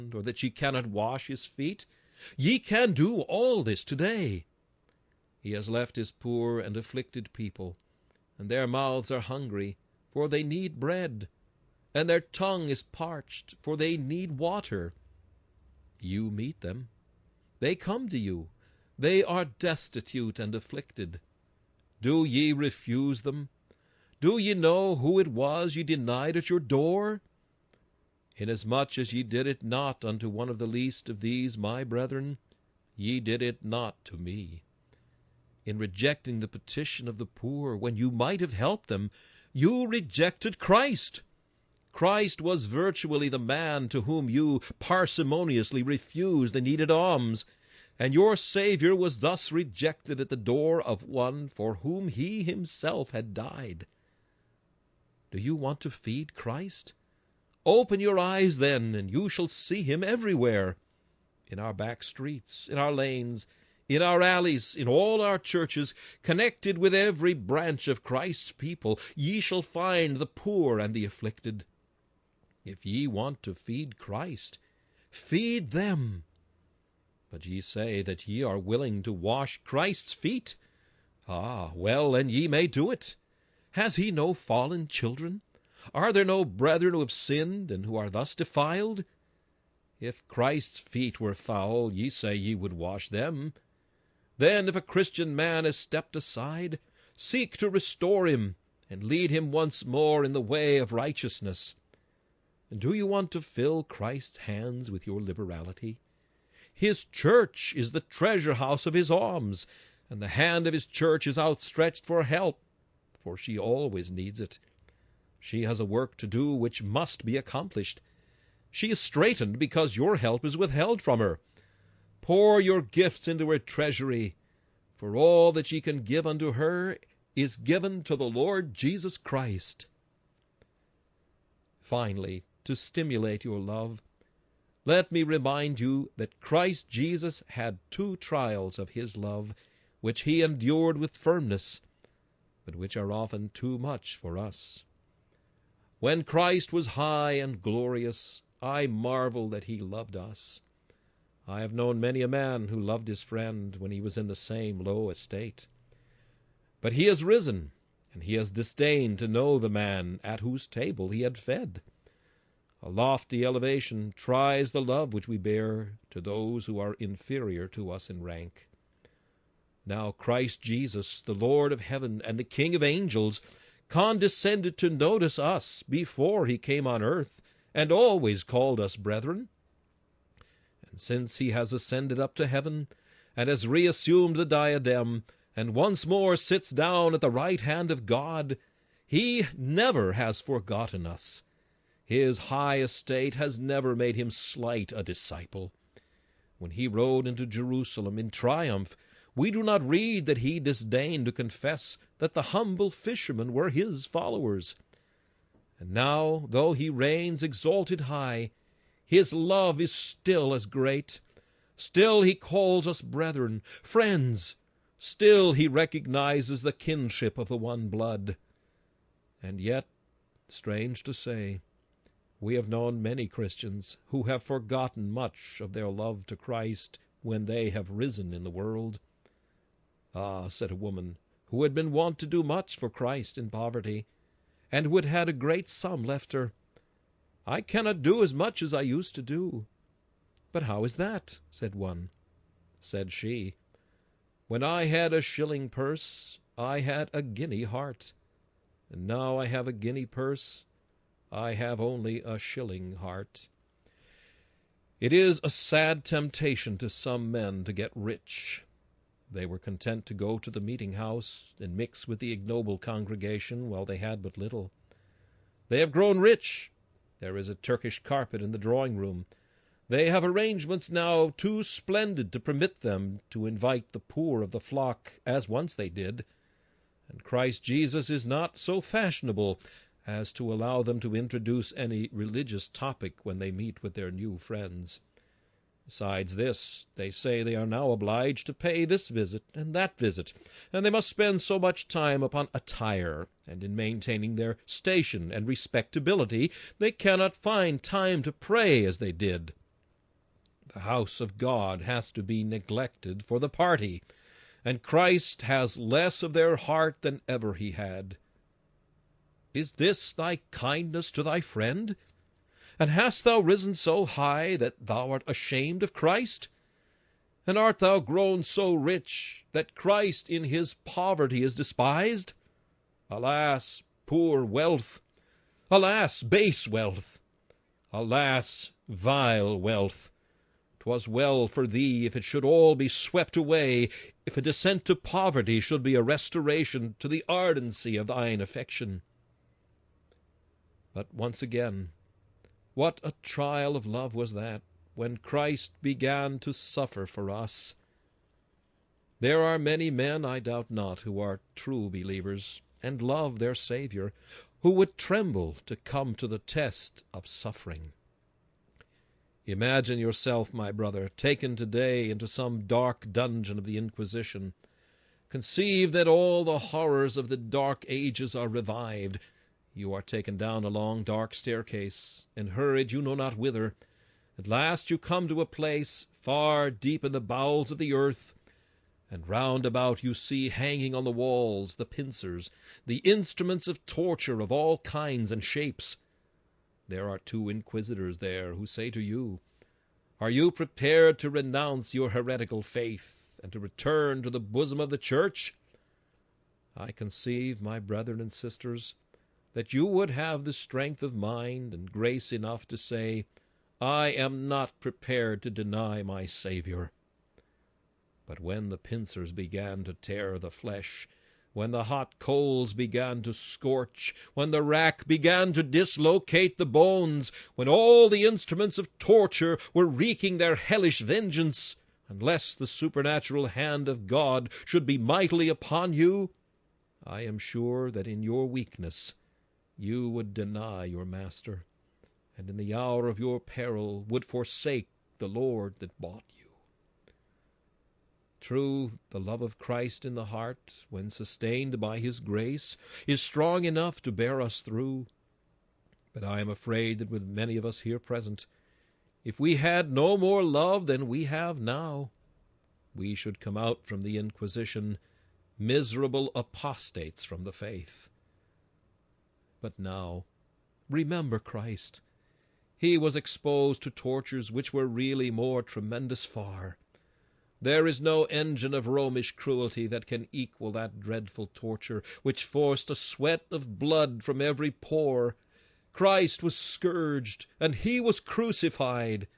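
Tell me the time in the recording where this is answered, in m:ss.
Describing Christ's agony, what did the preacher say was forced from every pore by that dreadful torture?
7:52.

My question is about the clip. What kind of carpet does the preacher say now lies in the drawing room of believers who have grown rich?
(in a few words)
Turkish carpet.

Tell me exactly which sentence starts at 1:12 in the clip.
If ye want to feed Christ, feed them.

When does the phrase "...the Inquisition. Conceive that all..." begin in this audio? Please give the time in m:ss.
6:03.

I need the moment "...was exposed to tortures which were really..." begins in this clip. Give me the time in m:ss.
7:42.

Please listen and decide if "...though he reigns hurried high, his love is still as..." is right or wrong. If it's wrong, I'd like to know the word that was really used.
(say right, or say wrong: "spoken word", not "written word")
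wrong: "exalted", not "hurried".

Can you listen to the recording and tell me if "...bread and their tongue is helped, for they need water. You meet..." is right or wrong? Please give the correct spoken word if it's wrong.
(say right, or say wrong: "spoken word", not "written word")
wrong: "parched", not "helped".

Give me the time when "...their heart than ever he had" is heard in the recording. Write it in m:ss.
5:06.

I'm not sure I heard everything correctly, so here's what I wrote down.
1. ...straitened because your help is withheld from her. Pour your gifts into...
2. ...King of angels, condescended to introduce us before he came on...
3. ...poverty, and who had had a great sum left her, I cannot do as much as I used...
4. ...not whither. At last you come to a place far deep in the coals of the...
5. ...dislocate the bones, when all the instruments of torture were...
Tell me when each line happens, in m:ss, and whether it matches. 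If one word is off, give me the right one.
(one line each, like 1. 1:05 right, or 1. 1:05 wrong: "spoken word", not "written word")
1. 1:59 right
2. 2:52 wrong: "notice", not "introduce"
3. 3:53 right
4. 6:13 wrong: "bowels", not "coals"
5. 6:55 right.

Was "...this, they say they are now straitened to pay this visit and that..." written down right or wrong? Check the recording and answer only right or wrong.
wrong.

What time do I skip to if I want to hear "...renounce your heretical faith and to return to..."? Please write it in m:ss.
6:31.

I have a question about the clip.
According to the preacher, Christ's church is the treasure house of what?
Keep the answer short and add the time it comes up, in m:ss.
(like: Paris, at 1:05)
his alms, at 1:48.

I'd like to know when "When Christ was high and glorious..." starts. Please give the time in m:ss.
2:25.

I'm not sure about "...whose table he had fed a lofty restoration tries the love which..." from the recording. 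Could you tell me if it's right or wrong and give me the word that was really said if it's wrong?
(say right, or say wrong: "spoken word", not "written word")
wrong: "elevation", not "restoration".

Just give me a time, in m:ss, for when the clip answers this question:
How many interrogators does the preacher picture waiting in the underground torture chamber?
6:27.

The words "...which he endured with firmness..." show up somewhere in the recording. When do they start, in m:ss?
2:20.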